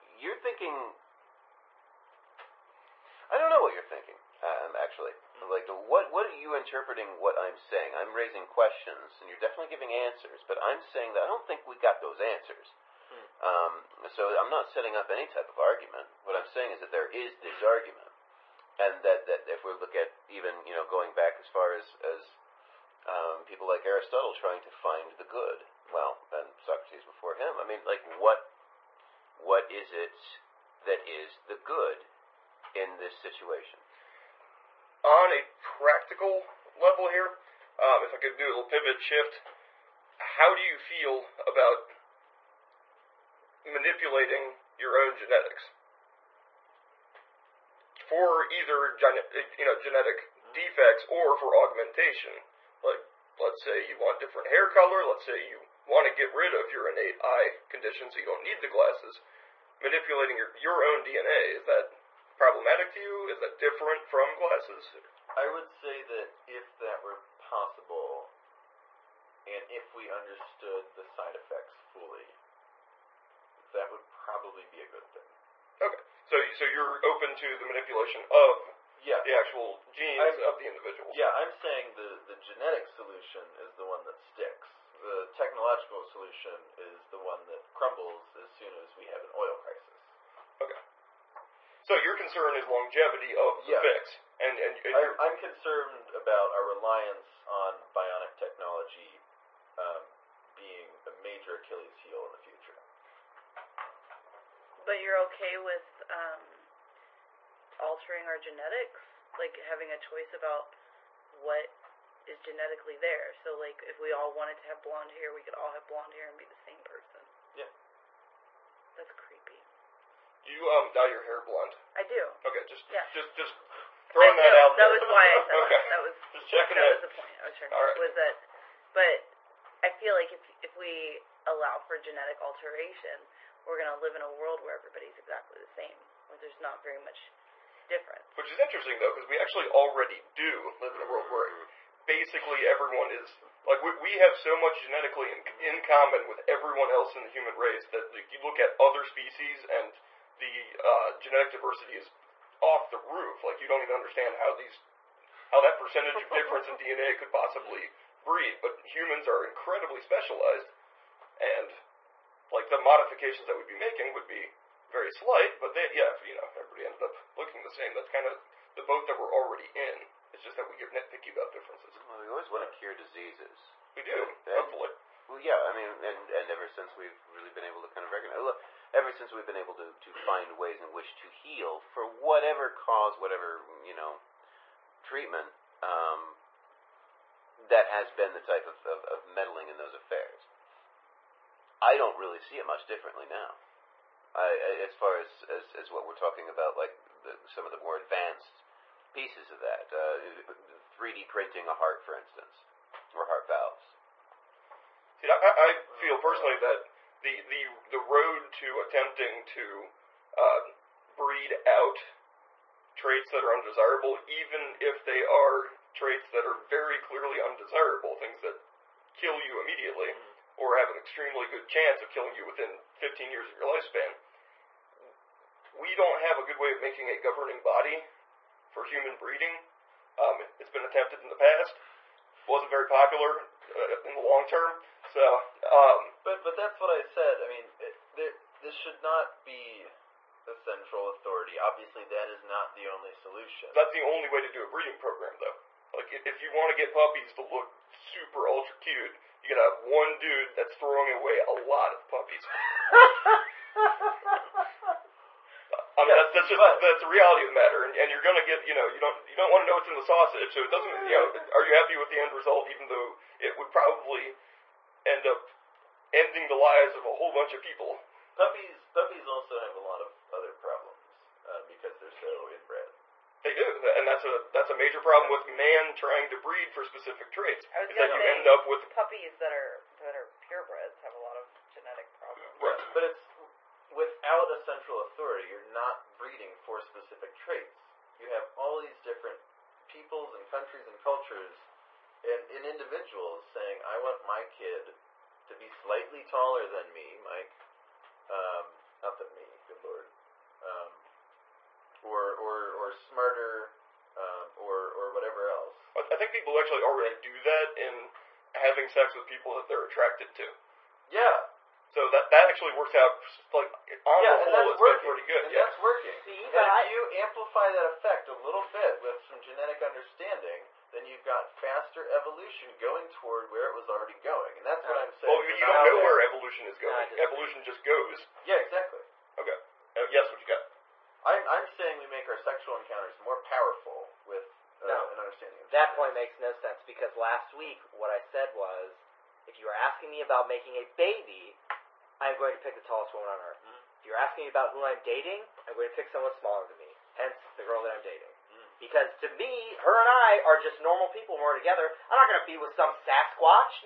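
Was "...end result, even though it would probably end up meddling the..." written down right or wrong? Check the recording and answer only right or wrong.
wrong.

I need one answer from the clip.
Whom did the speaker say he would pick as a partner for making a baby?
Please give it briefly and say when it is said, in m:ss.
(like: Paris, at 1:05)
The tallest woman on earth, at 5:42.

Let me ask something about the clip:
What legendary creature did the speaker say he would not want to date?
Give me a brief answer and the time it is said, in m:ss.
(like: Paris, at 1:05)
Sasquatch, at 5:52.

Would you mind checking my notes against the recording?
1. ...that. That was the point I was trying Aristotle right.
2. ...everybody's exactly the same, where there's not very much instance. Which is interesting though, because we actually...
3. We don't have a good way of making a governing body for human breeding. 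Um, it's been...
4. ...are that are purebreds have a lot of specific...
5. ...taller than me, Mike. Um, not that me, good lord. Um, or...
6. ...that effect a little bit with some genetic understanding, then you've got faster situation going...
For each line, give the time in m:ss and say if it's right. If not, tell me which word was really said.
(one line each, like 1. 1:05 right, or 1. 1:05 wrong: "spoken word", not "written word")
1. 2:06 wrong: "All", not "Aristotle"
2. 2:14 wrong: "difference", not "instance"
3. 3:45 right
4. 4:39 wrong: "genetic", not "specific"
5. 4:56 right
6. 5:17 wrong: "evolution", not "situation".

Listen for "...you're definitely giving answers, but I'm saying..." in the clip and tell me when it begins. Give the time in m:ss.
0:09.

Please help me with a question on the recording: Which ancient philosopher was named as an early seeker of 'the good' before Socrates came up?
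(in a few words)
Aristotle.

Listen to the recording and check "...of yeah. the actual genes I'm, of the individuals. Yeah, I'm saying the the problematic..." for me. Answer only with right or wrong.
wrong.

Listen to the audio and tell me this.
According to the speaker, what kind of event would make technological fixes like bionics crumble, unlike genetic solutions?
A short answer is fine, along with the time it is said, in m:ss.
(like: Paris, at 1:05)
An oil crisis, at 1:29.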